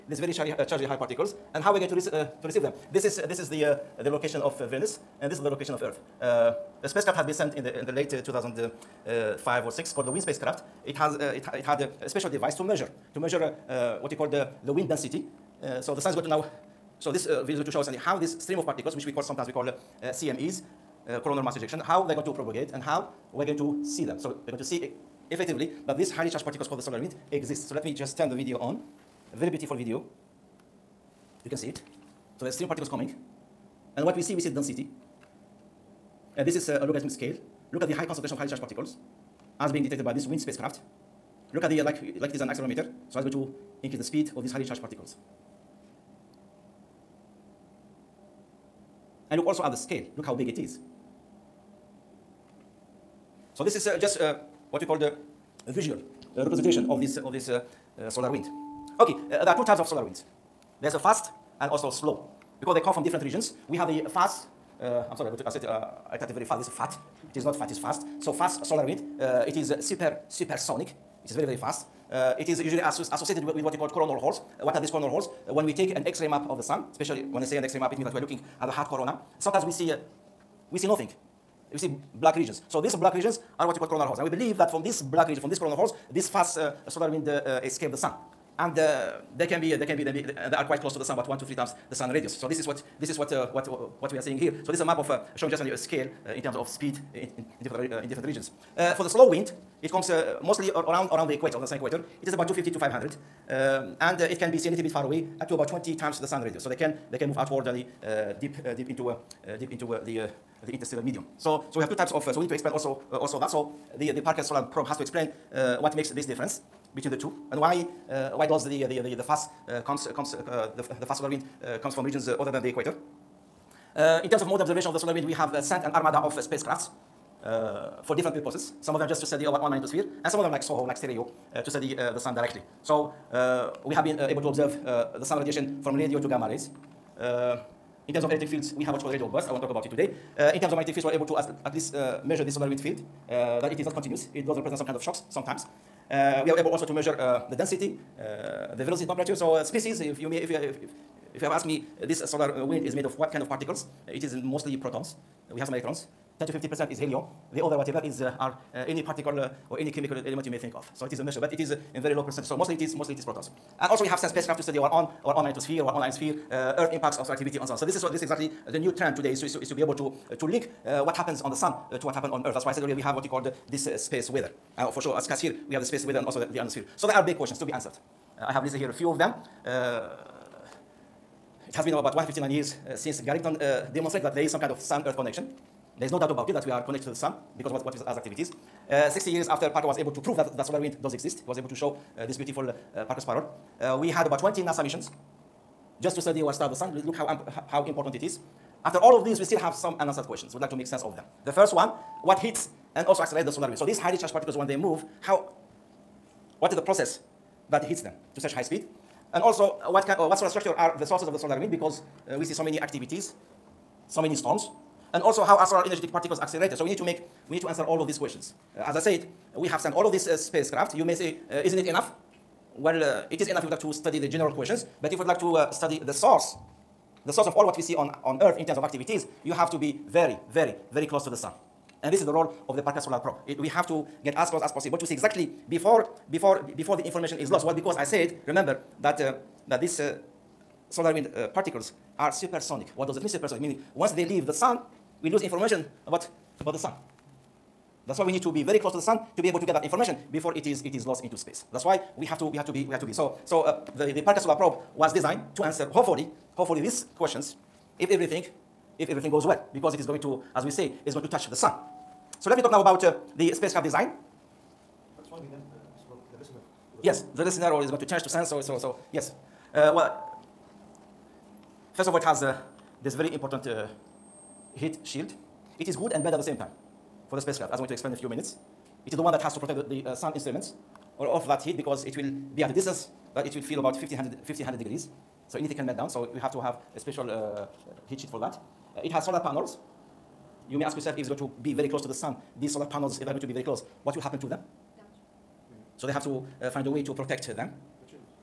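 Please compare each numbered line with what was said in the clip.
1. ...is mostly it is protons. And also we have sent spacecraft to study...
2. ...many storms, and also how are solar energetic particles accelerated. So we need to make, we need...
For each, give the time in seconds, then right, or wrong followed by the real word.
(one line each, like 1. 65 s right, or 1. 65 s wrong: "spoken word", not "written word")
1. 162 s right
2. 214 s right.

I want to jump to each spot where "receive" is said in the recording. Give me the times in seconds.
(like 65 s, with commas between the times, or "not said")
2 s.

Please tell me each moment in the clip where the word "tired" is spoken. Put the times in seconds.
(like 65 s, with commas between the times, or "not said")
not said.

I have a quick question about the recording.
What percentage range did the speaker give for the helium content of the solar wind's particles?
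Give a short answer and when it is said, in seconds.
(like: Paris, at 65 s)
10 to 50 percent, at 156 s.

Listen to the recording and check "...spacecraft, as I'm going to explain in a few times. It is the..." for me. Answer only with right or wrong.
wrong.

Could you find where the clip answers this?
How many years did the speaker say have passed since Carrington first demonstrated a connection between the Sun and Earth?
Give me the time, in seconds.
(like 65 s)
182 s.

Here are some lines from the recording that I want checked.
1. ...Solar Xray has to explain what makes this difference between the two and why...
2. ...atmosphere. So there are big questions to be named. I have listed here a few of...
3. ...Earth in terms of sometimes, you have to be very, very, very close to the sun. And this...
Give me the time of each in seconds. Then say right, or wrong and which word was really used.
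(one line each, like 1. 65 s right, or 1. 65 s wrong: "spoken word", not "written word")
1. 114 s wrong: "Probe", not "Xray"
2. 176 s wrong: "answered", not "named"
3. 228 s wrong: "activities", not "sometimes".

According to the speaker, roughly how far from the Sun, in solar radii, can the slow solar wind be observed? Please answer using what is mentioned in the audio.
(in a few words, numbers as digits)
20 times the sun radius.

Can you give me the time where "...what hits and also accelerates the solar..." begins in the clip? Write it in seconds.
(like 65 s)
202 s.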